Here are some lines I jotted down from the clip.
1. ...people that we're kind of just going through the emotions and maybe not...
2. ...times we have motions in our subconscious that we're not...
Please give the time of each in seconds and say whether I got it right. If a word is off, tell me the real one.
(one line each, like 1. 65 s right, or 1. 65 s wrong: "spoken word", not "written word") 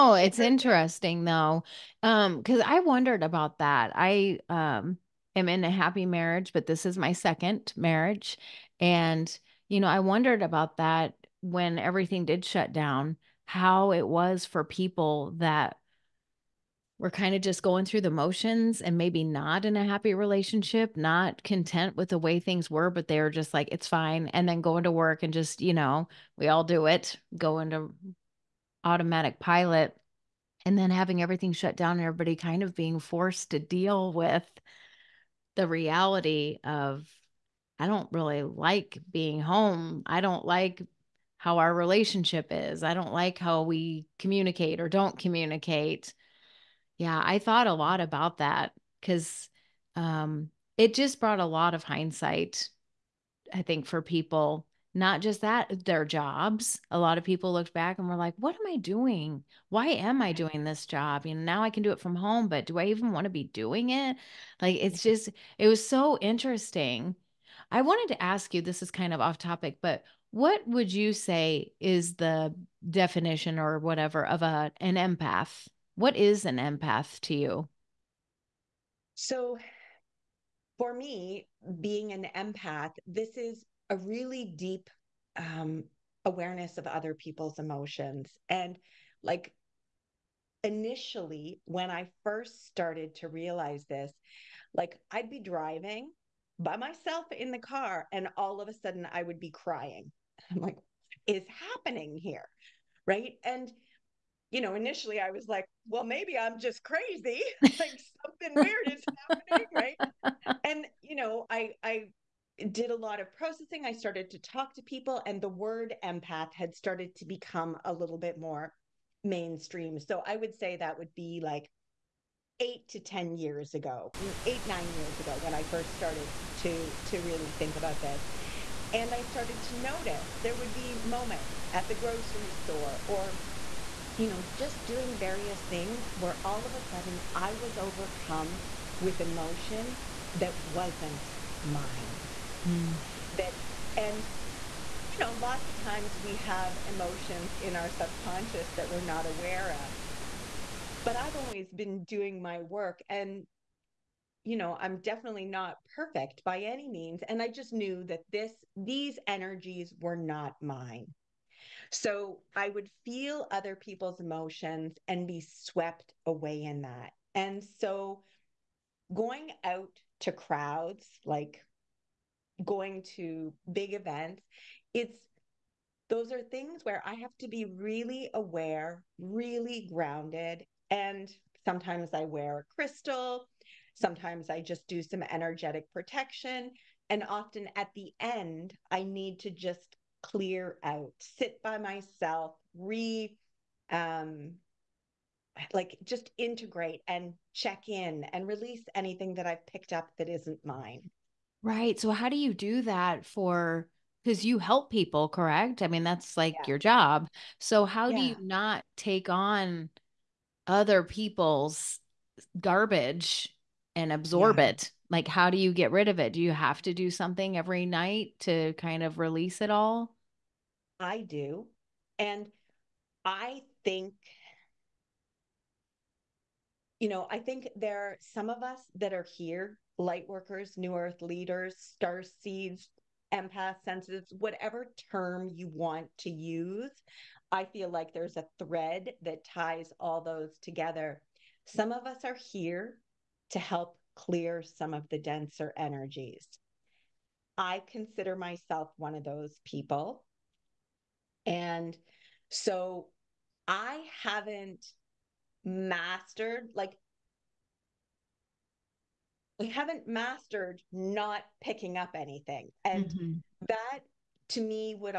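1. 14 s wrong: "motions", not "emotions"
2. 145 s wrong: "emotions", not "motions".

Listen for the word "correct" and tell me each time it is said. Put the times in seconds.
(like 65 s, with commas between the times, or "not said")
205 s.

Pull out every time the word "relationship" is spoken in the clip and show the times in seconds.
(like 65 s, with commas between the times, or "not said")
20 s, 41 s.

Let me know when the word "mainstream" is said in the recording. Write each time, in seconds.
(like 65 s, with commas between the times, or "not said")
119 s.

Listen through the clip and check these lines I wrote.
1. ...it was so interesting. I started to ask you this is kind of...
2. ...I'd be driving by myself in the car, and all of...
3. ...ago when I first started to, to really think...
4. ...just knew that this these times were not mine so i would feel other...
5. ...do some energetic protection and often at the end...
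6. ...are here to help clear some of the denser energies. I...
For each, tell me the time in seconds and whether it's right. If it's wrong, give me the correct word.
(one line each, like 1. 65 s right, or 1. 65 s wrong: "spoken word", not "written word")
1. 65 s wrong: "wanted", not "started"
2. 95 s right
3. 125 s right
4. 157 s wrong: "energies", not "times"
5. 184 s right
6. 242 s right.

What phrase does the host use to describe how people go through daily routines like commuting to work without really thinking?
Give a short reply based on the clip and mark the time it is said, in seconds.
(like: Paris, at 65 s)
automatic pilot, at 28 s.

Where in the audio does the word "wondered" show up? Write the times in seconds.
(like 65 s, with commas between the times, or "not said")
2 s, 9 s.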